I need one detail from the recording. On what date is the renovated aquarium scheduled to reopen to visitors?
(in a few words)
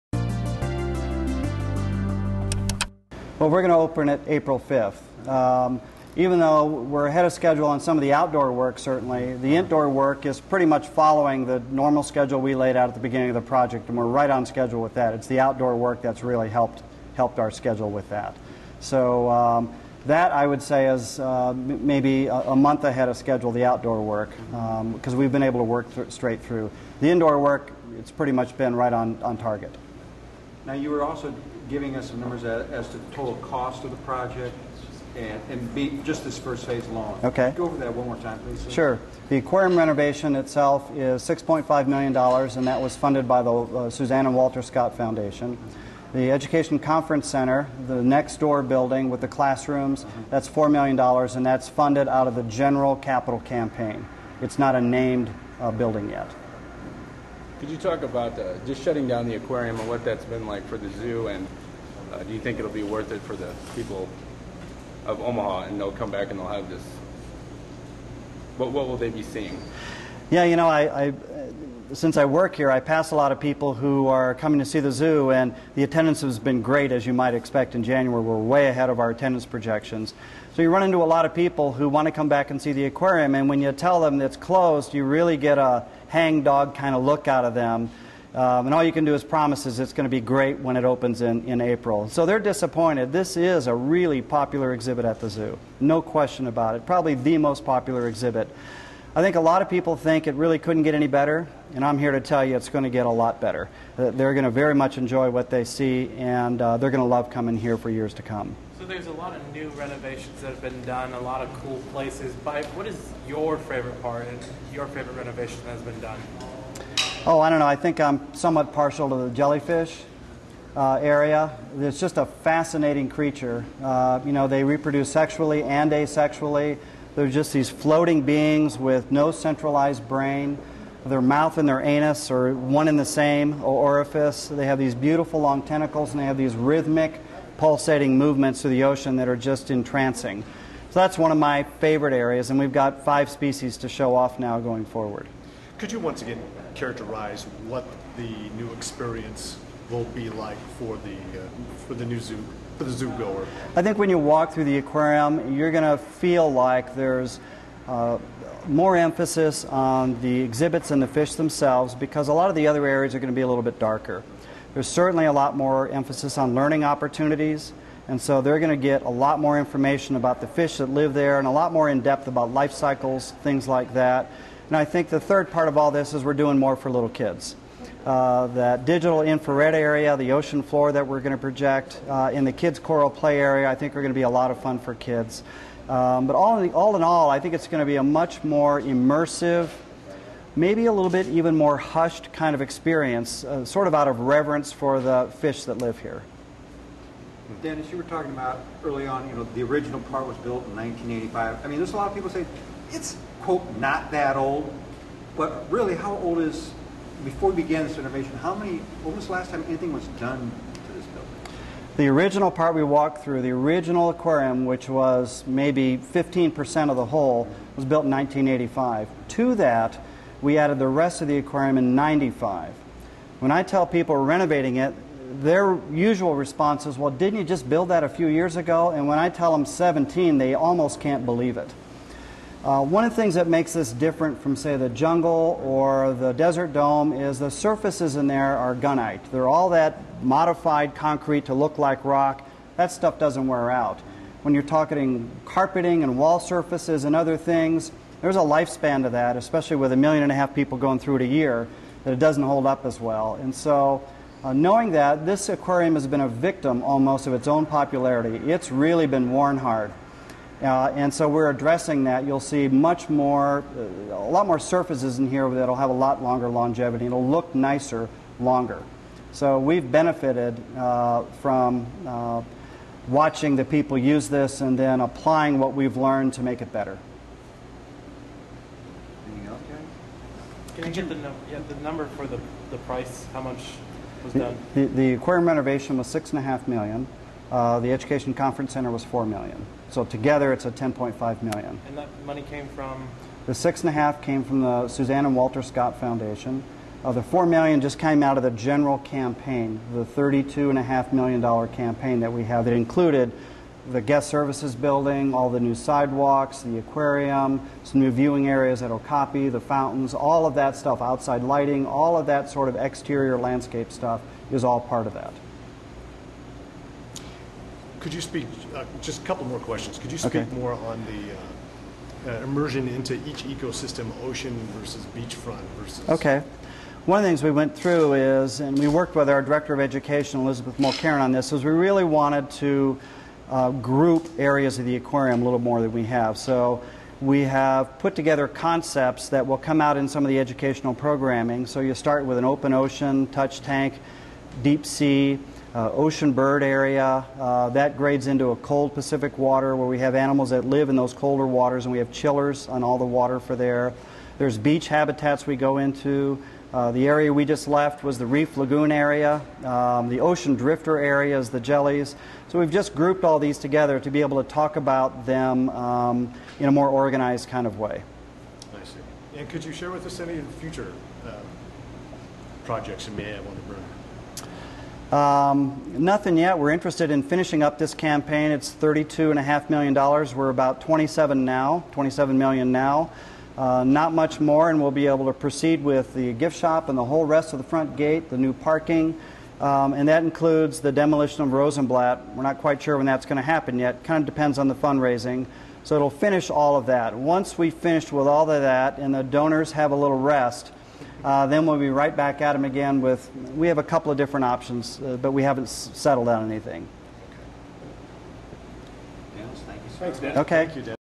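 April 5th.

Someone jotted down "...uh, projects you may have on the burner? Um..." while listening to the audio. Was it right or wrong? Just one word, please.
right.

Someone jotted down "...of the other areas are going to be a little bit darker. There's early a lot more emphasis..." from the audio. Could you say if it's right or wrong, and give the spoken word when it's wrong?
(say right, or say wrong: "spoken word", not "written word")
wrong: "certainly", not "early".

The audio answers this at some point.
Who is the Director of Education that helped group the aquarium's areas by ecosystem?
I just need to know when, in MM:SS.
05:30.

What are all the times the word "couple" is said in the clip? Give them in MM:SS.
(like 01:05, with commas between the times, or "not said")
05:19, 06:43.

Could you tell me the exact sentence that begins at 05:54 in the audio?
There's beach habitats we go into.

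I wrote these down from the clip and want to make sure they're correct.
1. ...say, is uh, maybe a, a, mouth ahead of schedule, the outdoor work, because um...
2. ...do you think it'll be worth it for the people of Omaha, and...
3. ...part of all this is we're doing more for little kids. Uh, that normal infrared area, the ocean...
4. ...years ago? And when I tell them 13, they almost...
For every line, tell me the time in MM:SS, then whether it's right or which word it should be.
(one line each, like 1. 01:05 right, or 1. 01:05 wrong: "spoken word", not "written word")
1. 00:20 wrong: "month", not "mouth"
2. 01:02 right
3. 02:55 wrong: "digital", not "normal"
4. 03:48 wrong: "17", not "13".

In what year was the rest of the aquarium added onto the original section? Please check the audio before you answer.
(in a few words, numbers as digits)
1995.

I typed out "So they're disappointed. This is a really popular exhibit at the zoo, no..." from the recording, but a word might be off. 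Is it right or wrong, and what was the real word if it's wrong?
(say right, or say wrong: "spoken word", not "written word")
right.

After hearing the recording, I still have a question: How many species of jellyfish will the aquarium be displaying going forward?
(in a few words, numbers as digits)
5.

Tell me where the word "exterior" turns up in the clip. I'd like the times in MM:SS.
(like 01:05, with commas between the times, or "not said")
05:12.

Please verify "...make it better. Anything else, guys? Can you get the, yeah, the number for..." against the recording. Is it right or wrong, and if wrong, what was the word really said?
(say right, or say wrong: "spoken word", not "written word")
right.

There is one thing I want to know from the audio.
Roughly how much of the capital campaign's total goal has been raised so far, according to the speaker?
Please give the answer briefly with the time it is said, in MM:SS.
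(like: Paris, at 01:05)
$27 million, at 06:21.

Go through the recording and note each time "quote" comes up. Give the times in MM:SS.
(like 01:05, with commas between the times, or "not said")
03:23.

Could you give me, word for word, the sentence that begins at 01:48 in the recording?
So there's a lot of new renovations that have been done, a lot of cool places.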